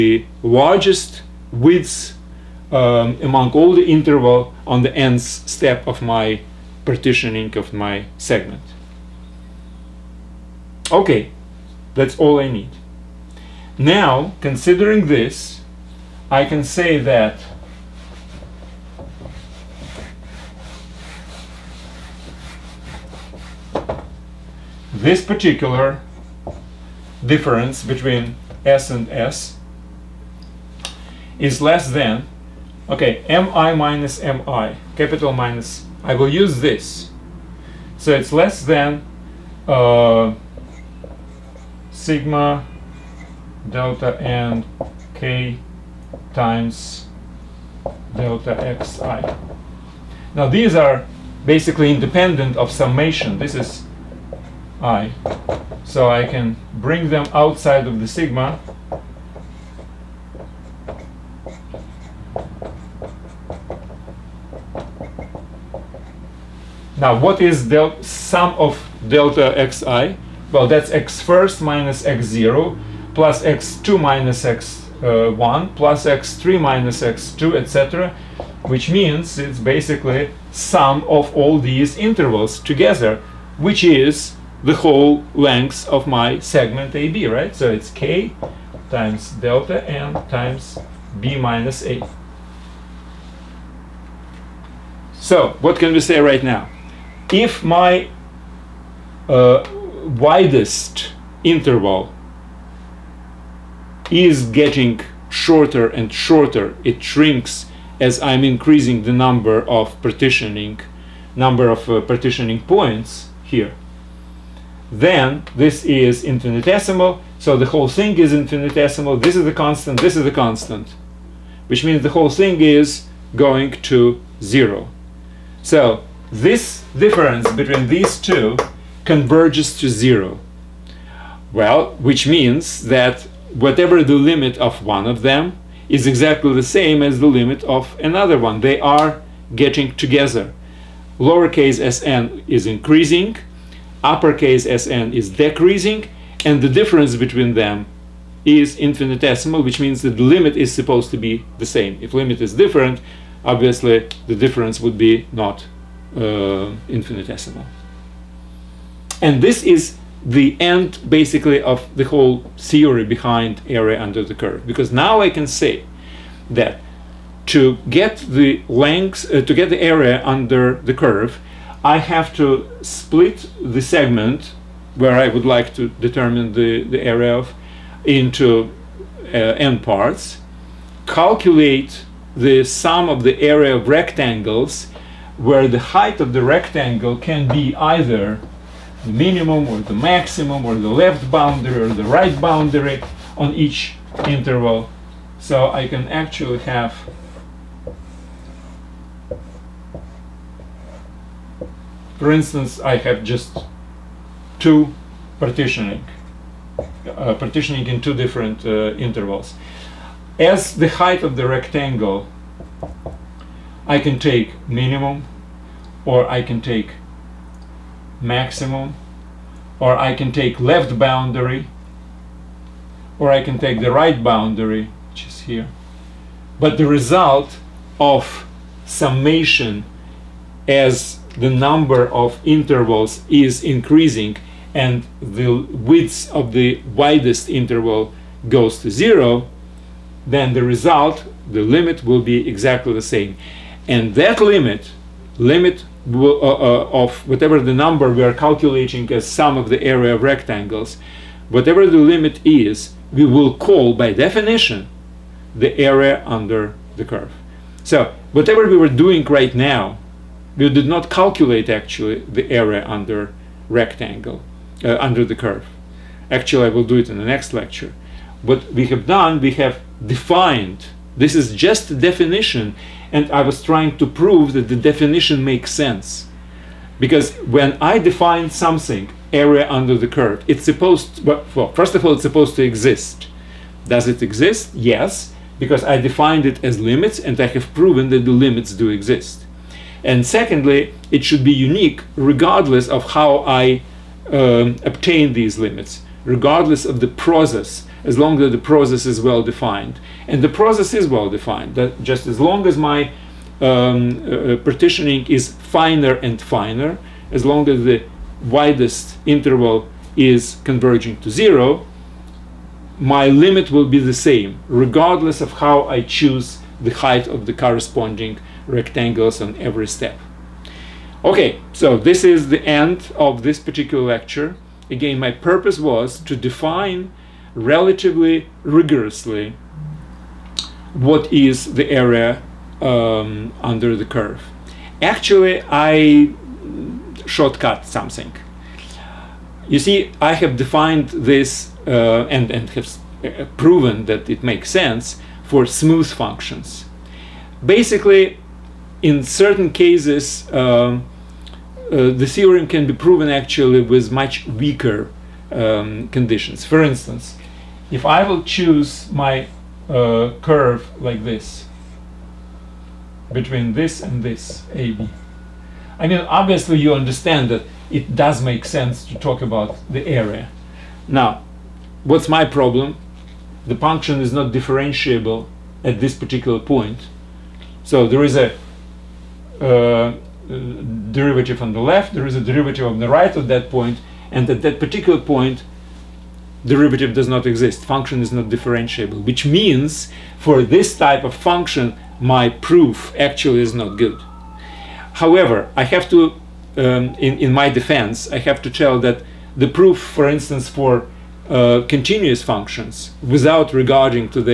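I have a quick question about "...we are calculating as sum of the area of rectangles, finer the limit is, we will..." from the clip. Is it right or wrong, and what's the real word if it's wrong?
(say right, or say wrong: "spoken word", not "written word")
wrong: "whatever", not "finer".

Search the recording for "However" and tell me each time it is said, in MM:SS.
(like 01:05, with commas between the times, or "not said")
06:35.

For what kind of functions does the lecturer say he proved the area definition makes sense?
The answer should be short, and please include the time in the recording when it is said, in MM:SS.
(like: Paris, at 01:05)
smooth functions, at 05:45.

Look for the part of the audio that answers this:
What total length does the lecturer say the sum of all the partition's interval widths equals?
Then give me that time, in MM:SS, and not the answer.
01:31.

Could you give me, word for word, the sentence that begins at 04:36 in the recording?
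Because when I define something, area under the curve, it's supposed, to, well, first of all, it's supposed to exist.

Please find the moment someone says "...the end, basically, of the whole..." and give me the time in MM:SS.
02:40.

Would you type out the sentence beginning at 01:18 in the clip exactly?
Which means it's basically sum of all these intervals together, which is the whole length of my segment AB, right?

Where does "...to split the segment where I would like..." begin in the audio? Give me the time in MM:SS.
02:52.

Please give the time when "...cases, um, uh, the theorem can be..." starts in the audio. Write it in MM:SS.
05:49.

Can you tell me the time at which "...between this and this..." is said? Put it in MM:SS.
06:03.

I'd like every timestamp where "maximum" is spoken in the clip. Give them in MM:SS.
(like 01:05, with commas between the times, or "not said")
03:09, 03:38.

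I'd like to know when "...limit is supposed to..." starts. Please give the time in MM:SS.
02:30.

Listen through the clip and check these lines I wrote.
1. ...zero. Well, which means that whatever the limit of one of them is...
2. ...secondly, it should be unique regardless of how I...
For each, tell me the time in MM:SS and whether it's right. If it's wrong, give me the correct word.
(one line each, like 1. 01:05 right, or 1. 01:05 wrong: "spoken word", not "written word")
1. 02:09 right
2. 04:50 right.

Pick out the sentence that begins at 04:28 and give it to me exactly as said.
What we have done, we have defined.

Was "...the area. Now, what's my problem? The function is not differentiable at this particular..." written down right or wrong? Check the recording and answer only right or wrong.
right.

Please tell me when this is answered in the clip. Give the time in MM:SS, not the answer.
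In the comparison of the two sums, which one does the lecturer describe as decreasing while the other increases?
02:24.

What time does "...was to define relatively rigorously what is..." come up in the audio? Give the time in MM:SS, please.
05:25.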